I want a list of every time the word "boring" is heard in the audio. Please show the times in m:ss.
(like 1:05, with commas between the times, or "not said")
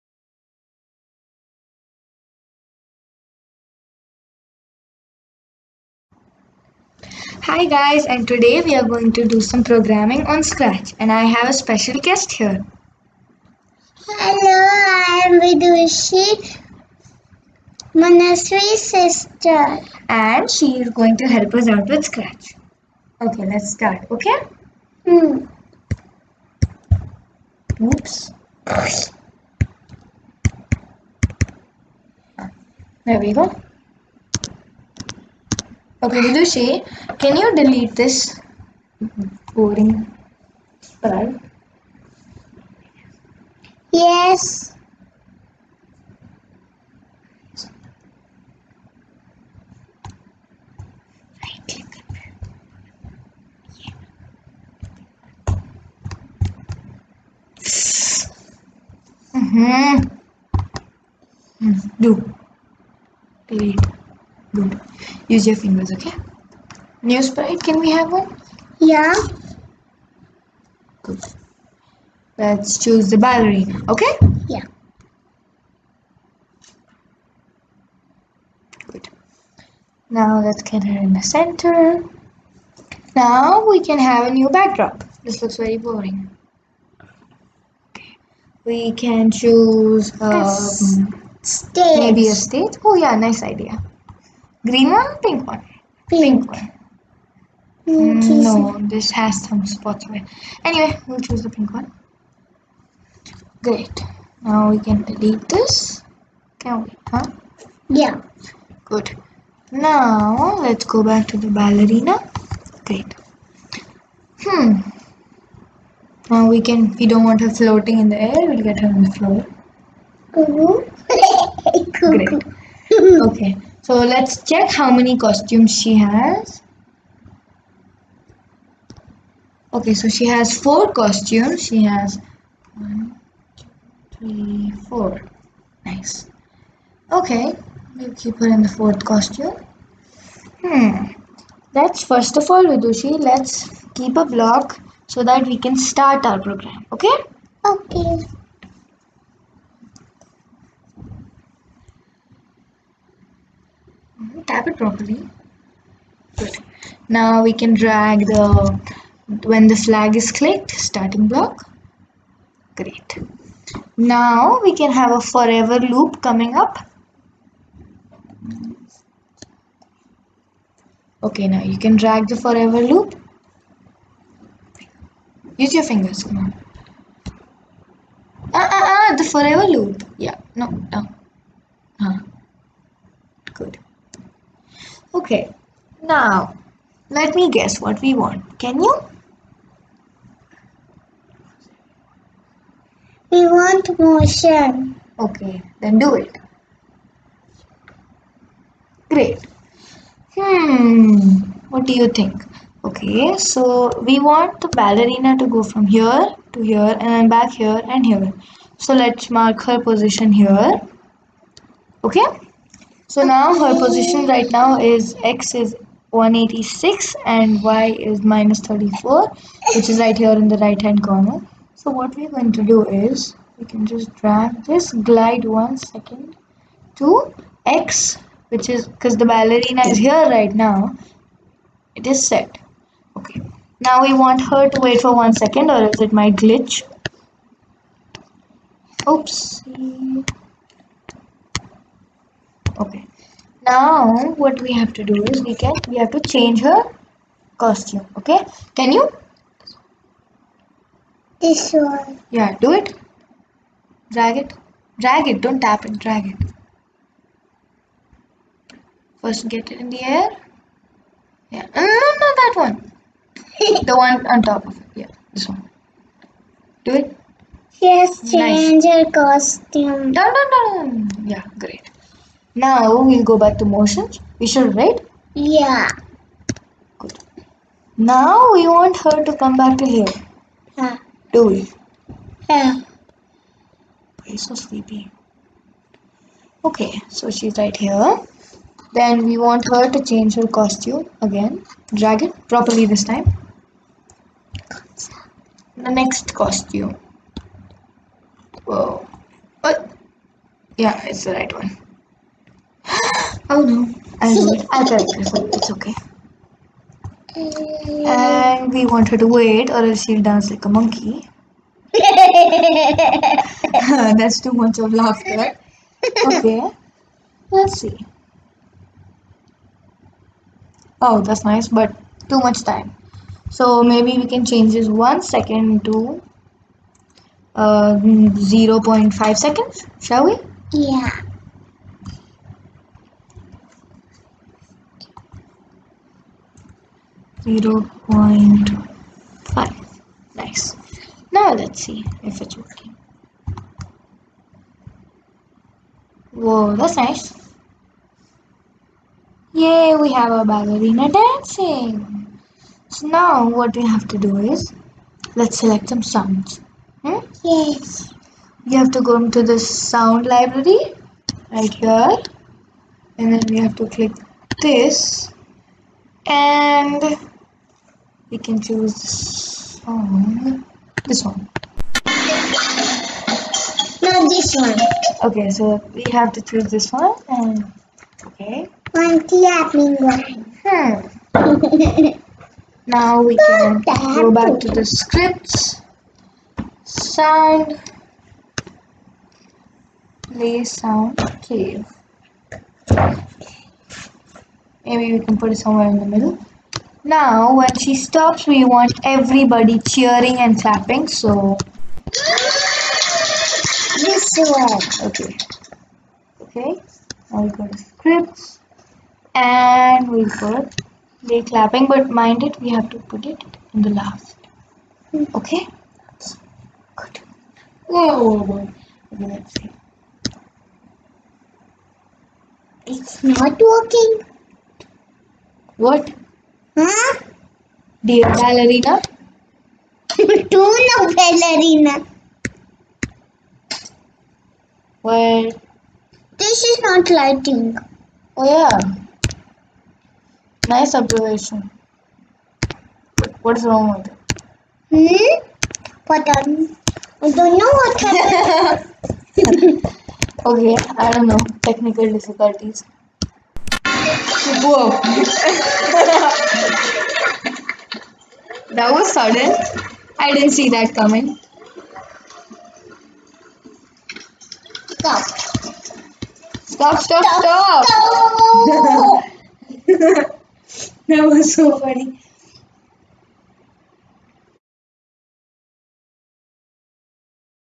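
0:39, 1:25.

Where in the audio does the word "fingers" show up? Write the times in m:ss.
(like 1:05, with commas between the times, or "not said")
1:05, 2:55.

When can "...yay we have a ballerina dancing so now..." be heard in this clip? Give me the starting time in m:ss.
5:49.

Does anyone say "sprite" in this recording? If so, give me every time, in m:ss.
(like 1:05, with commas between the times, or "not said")
0:40, 1:07.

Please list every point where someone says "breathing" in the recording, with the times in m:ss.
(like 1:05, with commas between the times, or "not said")
not said.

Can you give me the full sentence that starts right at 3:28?
So let's mark her position here.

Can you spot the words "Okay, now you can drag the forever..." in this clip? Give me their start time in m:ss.
2:51.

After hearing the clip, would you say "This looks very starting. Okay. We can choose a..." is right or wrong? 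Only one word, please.
wrong.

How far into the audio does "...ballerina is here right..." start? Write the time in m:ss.
3:49.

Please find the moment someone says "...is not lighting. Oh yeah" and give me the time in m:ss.
7:16.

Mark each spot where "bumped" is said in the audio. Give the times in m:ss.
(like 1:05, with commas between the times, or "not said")
not said.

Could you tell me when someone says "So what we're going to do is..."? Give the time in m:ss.
3:41.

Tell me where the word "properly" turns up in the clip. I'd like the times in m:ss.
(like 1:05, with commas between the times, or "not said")
2:34, 4:52.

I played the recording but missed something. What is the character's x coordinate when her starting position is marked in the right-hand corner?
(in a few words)
186.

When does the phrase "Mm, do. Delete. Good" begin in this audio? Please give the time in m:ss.
1:01.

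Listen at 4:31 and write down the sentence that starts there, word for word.
yeah great now we'll go back to motions.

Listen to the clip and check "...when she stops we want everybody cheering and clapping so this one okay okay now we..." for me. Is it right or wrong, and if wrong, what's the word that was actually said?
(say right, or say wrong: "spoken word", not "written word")
right.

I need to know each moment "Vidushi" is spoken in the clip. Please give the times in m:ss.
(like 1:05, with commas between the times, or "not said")
0:15, 0:36, 2:22.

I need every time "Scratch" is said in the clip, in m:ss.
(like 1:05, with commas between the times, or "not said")
0:10, 0:22.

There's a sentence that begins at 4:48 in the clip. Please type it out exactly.
Then we want her to change her costume again.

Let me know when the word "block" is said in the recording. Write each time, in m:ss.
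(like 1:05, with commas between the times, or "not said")
2:24, 2:41.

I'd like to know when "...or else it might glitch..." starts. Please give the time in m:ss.
3:55.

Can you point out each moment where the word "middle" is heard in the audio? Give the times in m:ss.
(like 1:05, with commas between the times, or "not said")
6:36.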